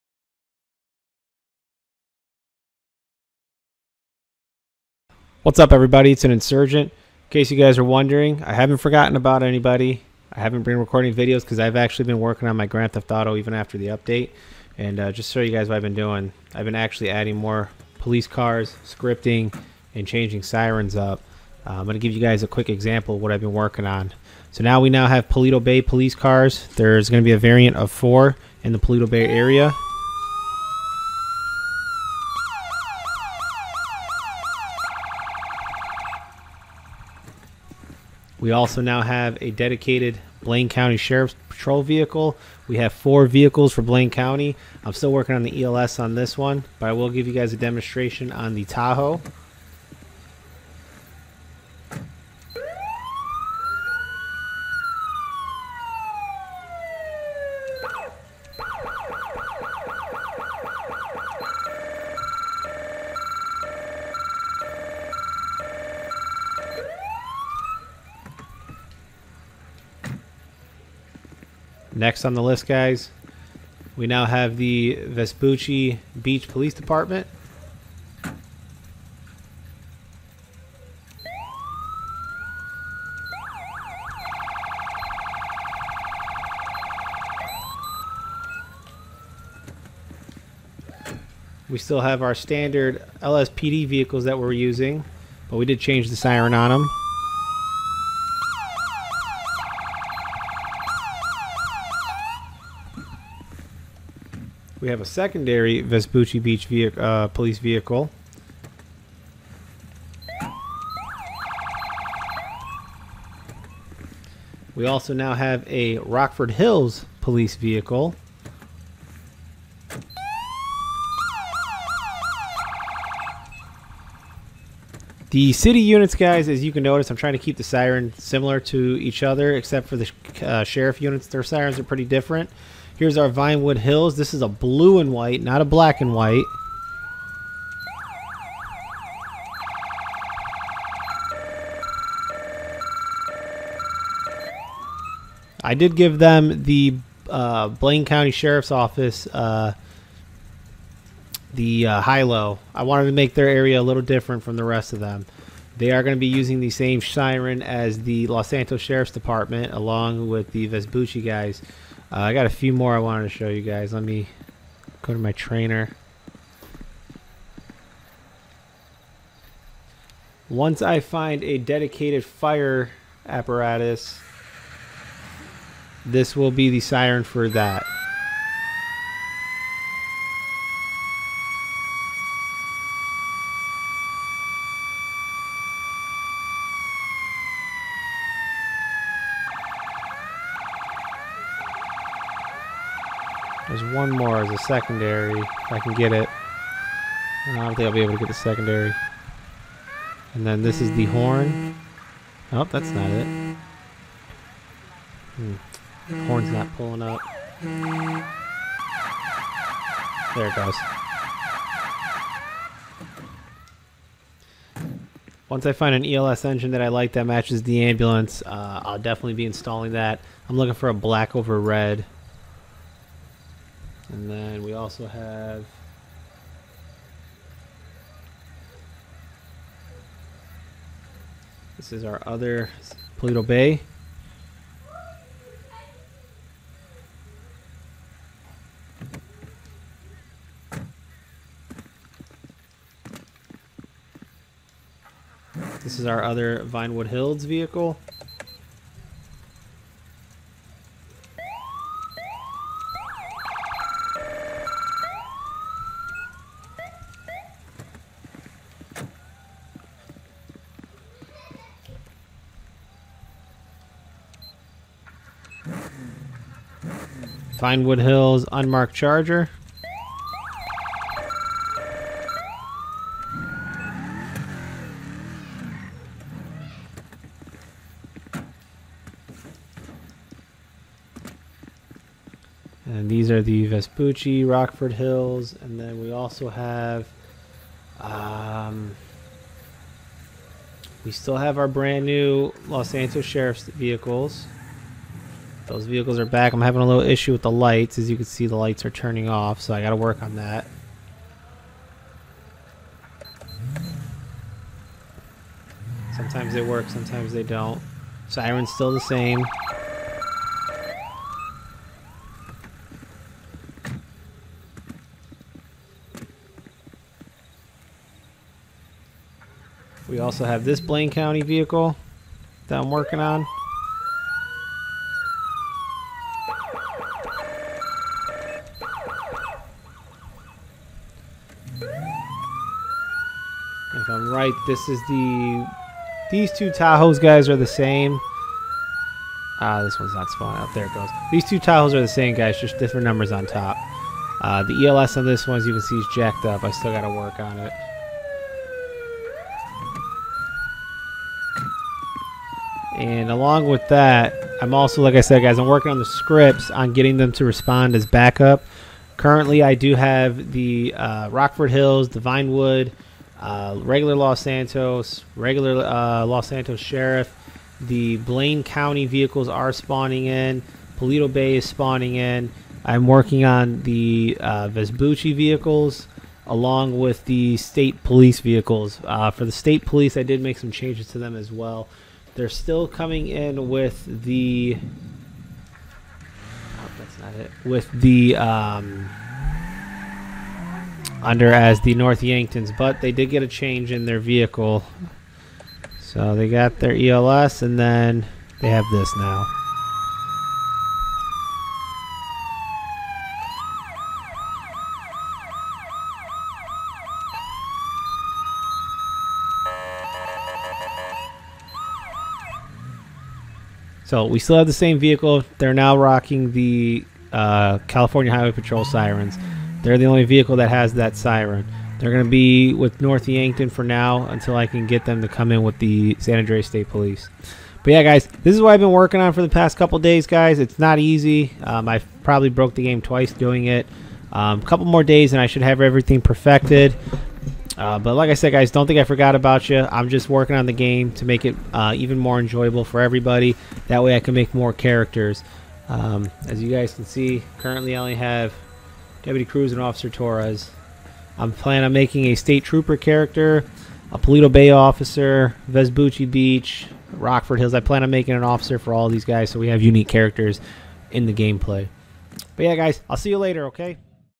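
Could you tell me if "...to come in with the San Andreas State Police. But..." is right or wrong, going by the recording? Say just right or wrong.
right.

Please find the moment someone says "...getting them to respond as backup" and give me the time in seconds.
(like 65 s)
356 s.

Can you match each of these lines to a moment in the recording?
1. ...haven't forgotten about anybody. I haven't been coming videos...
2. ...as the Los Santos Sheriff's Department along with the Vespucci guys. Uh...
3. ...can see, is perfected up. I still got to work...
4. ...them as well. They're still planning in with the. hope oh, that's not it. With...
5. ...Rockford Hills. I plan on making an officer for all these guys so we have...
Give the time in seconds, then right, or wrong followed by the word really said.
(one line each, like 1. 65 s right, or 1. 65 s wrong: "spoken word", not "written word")
1. 8 s wrong: "recording", not "coming"
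2. 157 s right
3. 345 s wrong: "jacked", not "perfected"
4. 381 s wrong: "coming", not "planning"
5. 457 s right.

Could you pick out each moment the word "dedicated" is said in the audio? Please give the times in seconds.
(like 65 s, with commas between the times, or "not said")
39 s, 171 s.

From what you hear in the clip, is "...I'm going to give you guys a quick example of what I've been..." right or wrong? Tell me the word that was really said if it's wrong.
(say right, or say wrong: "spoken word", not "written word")
right.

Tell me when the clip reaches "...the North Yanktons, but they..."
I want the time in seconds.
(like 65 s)
391 s.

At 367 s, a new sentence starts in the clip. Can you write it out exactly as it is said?
The Blaine County vehicles are spawning in.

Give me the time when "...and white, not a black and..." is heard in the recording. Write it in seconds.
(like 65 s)
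134 s.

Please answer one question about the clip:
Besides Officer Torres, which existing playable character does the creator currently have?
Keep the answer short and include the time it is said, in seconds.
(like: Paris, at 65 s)
Deputy Cruz, at 449 s.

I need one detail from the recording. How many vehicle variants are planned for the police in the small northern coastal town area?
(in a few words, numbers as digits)
4.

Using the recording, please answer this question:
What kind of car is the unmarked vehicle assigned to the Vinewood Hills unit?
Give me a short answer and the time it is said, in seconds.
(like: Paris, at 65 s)
Charger, at 268 s.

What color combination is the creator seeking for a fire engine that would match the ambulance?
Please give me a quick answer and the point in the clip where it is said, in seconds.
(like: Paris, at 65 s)
black over red, at 220 s.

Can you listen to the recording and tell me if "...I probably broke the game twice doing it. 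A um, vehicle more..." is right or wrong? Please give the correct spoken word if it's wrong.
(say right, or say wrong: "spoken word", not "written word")
wrong: "couple", not "vehicle".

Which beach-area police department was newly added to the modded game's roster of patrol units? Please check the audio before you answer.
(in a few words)
Vespucci Beach Police Department.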